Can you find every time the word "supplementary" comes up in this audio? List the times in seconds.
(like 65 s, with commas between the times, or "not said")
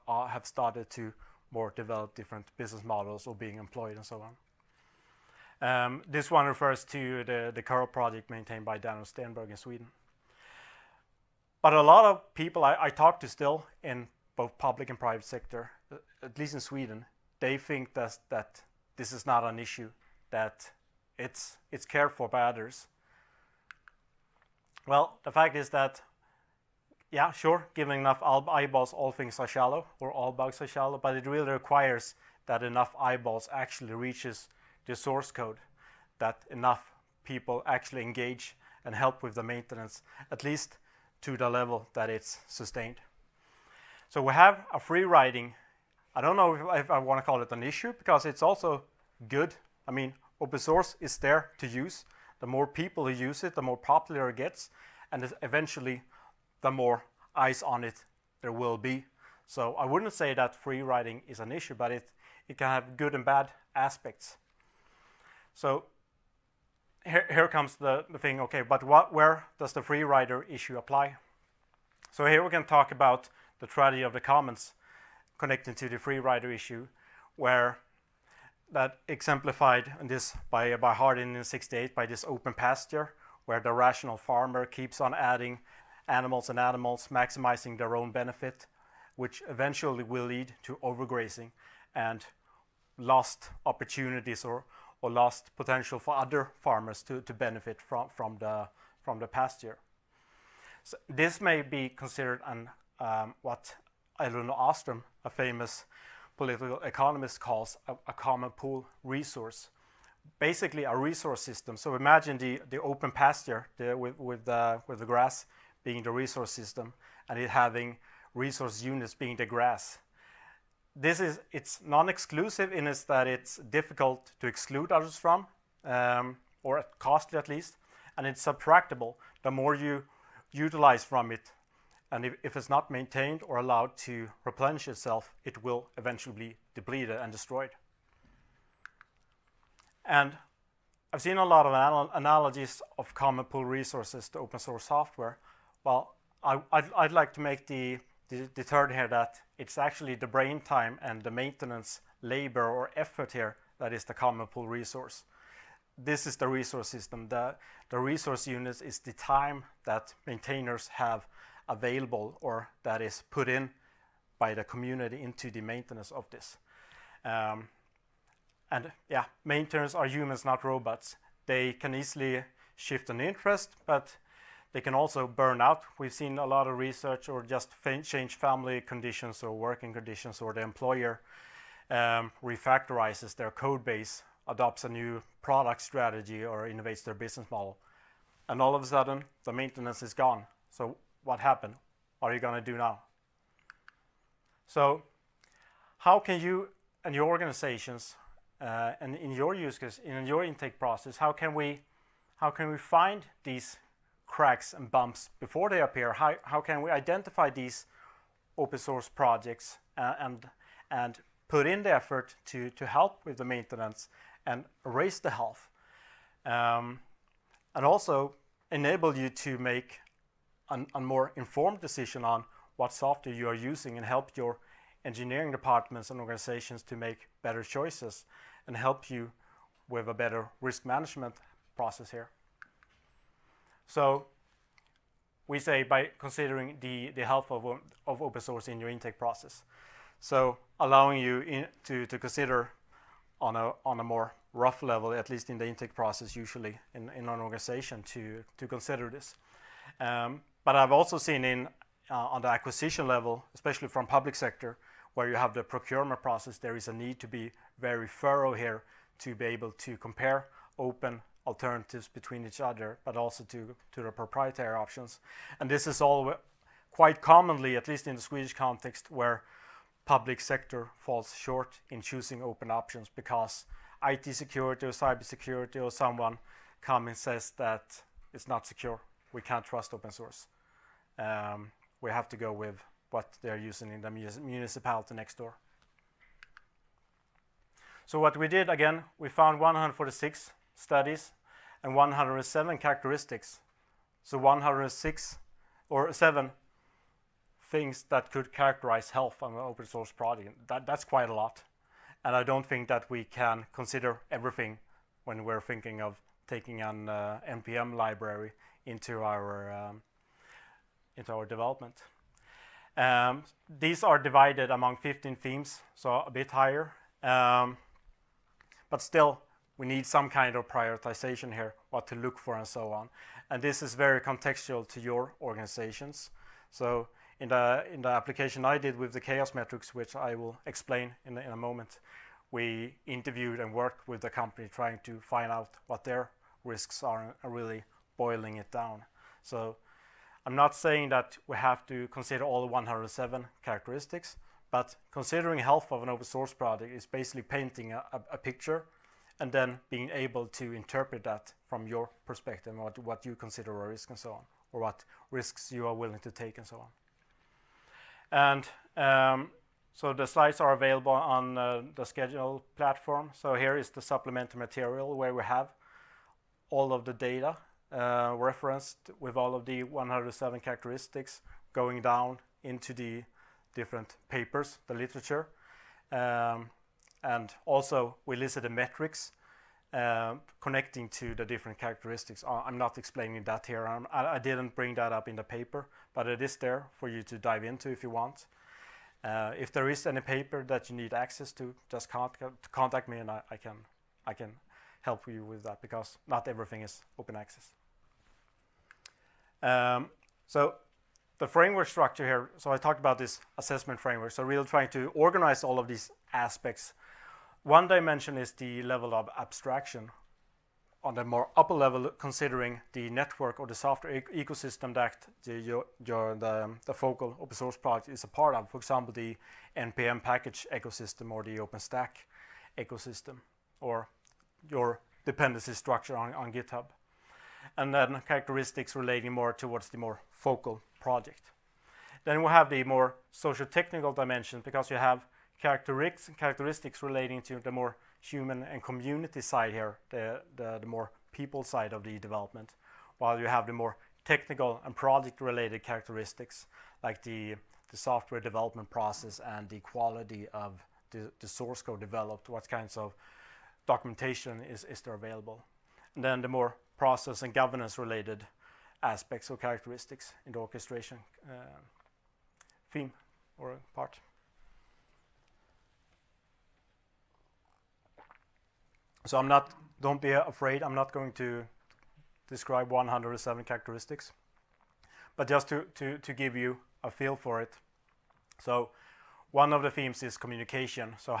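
364 s.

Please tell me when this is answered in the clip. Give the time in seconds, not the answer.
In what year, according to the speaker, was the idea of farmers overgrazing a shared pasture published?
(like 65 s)
81 s.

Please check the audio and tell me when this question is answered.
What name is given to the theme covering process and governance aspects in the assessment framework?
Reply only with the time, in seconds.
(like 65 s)
460 s.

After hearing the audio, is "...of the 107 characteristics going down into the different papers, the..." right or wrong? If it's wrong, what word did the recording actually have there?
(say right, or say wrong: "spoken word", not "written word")
right.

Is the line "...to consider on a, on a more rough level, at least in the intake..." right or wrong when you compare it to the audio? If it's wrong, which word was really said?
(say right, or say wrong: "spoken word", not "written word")
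right.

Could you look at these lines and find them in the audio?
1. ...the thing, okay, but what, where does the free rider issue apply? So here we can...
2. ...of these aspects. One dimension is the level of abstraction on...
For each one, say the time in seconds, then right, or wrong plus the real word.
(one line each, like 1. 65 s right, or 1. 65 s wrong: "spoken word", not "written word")
1. 68 s right
2. 405 s right.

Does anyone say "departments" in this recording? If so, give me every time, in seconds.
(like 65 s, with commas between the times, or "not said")
225 s.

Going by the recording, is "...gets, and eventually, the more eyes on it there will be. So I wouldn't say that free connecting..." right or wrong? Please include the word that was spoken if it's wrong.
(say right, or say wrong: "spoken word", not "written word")
wrong: "riding", not "connecting".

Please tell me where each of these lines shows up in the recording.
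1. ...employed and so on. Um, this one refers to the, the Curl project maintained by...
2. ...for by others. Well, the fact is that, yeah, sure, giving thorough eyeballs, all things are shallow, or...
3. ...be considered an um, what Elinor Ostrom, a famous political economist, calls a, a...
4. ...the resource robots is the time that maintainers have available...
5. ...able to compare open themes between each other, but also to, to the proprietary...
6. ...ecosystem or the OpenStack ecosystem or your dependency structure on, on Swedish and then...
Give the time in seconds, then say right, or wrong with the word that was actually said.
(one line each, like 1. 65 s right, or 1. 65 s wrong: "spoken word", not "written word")
1. 3 s right
2. 22 s wrong: "enough", not "thorough"
3. 101 s right
4. 157 s wrong: "units", not "robots"
5. 259 s wrong: "alternatives", not "themes"
6. 420 s wrong: "GitHub", not "Swedish".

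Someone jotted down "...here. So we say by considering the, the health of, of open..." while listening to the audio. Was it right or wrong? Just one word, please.
right.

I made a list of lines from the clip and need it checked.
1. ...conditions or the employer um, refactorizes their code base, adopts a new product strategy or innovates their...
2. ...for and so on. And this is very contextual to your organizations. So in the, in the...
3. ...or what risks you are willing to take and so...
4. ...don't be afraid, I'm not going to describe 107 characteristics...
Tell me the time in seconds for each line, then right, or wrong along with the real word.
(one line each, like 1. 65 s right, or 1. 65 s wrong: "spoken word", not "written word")
1. 179 s right
2. 322 s right
3. 354 s right
4. 470 s right.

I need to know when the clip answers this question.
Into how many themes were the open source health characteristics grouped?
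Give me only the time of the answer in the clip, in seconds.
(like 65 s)
314 s.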